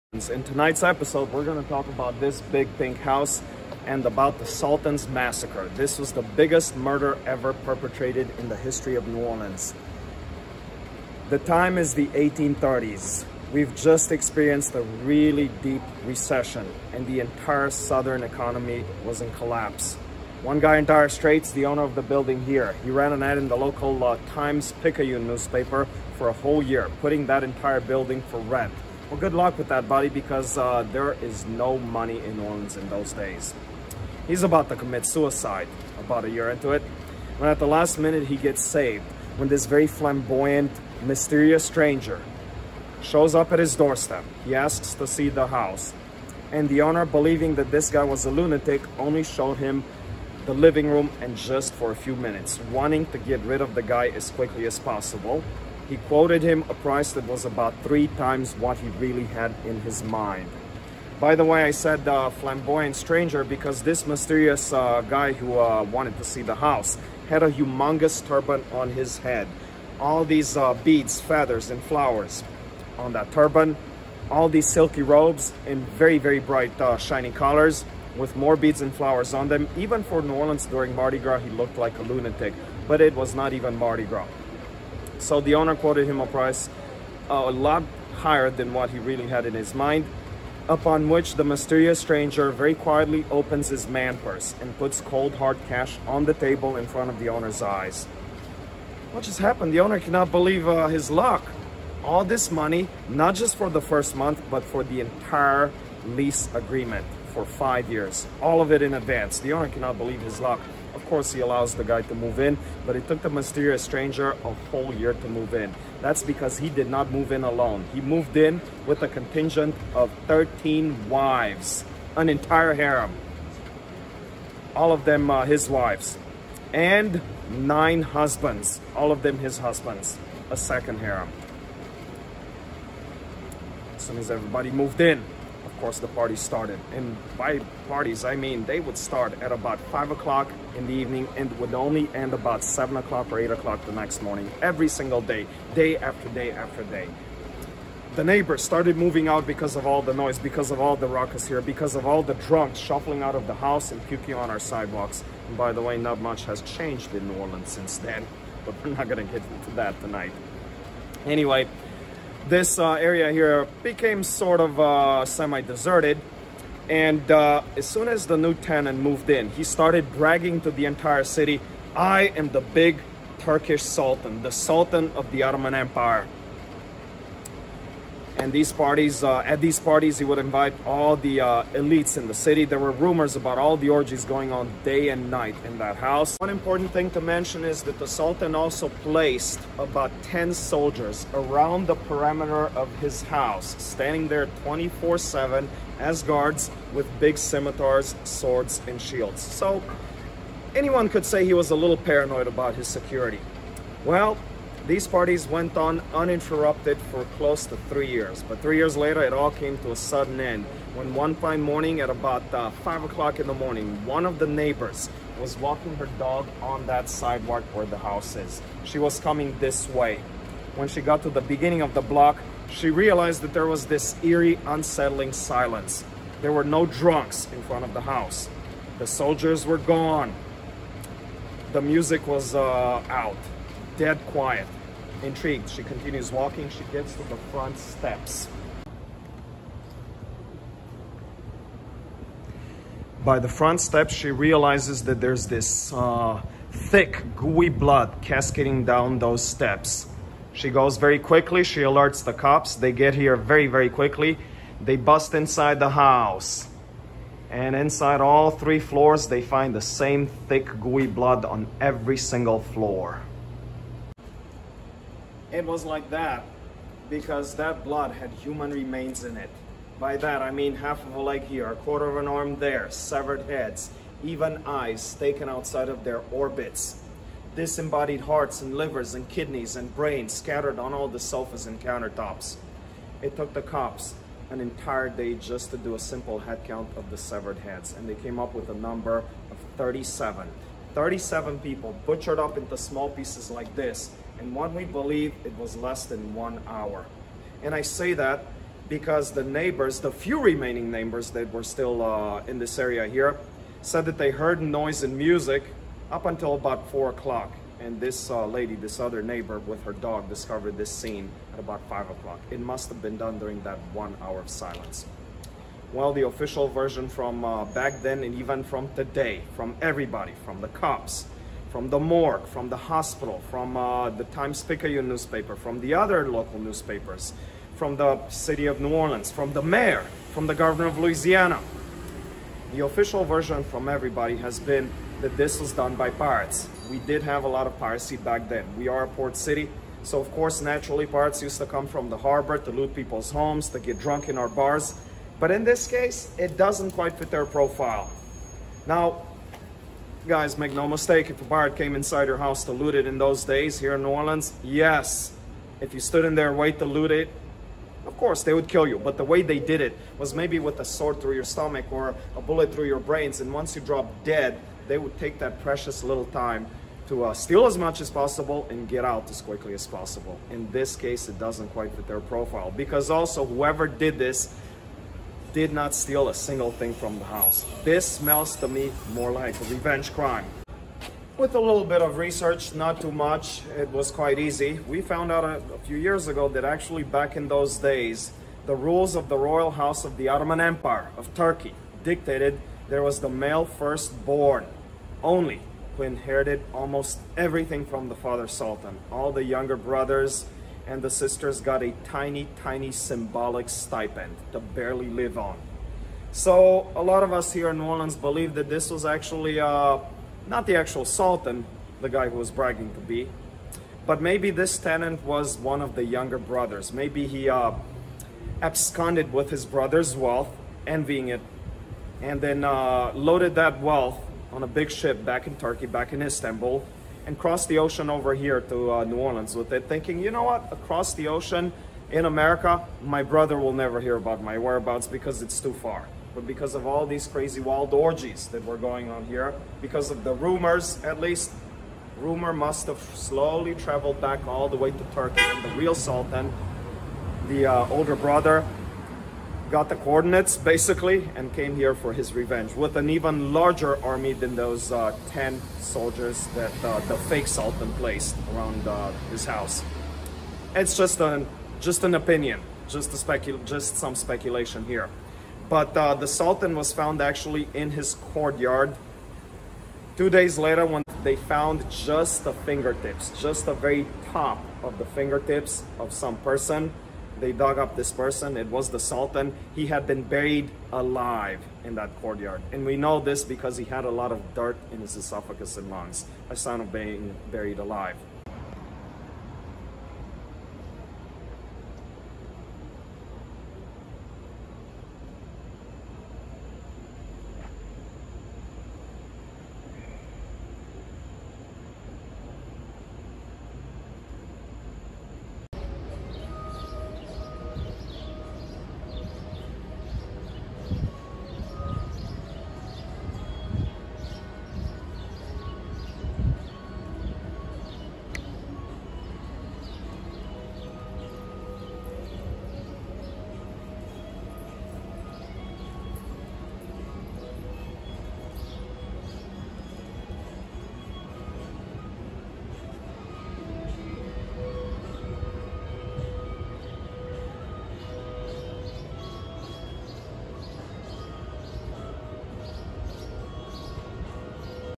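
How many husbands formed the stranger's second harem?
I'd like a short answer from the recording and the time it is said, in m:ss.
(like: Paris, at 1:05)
9, at 2:07.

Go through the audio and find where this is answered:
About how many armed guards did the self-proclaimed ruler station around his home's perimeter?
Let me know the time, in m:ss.
3:09.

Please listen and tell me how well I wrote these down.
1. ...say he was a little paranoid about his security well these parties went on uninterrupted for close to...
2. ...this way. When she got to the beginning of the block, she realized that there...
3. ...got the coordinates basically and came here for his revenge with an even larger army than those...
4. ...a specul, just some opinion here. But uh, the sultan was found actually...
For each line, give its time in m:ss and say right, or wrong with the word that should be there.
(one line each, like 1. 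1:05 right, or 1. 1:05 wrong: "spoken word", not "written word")
1. 3:21 right
2. 3:39 right
3. 7:29 right
4. 7:43 wrong: "speculation", not "opinion".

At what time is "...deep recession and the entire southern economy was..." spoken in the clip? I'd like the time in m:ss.
0:15.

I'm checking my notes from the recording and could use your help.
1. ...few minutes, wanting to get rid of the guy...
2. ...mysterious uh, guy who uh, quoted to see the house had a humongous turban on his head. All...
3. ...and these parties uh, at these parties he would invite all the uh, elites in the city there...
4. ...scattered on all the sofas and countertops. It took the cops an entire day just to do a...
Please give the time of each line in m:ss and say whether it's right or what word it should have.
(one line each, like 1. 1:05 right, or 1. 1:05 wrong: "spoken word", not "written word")
1. 0:51 right
2. 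1:04 wrong: "wanted", not "quoted"
3. 2:58 right
4. 4:40 right.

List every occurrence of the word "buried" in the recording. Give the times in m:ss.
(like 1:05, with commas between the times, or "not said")
8:00, 8:07.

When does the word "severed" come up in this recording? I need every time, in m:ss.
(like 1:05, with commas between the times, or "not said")
4:32, 4:47.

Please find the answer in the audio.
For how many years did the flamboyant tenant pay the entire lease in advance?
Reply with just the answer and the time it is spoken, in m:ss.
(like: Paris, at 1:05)
5, at 1:47.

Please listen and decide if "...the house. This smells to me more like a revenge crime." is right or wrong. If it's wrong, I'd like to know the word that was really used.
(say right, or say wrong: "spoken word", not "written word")
right.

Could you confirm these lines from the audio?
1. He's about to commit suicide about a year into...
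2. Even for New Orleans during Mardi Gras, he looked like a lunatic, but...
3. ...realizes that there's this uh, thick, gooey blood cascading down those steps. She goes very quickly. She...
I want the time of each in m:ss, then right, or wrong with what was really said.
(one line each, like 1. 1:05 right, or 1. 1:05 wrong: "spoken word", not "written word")
1. 0:34 right
2. 1:19 right
3. 4:04 right.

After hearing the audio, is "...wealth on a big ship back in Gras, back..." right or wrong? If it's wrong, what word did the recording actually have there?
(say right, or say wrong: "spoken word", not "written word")
wrong: "Turkey", not "Gras".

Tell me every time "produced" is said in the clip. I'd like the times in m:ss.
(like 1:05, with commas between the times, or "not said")
not said.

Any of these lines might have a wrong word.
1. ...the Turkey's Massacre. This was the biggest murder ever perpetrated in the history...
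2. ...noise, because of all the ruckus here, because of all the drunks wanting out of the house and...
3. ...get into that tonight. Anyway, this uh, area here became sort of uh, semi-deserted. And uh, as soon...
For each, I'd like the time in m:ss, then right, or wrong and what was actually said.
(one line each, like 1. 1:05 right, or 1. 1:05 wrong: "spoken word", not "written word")
1. 0:04 wrong: "Sultan", not "Turkey"
2. 2:30 wrong: "shuffling", not "wanting"
3. 2:39 right.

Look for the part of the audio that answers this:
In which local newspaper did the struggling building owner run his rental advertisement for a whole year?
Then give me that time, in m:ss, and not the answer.
0:24.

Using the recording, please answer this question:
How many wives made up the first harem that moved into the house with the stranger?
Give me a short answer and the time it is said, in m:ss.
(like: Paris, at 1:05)
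13, at 2:00.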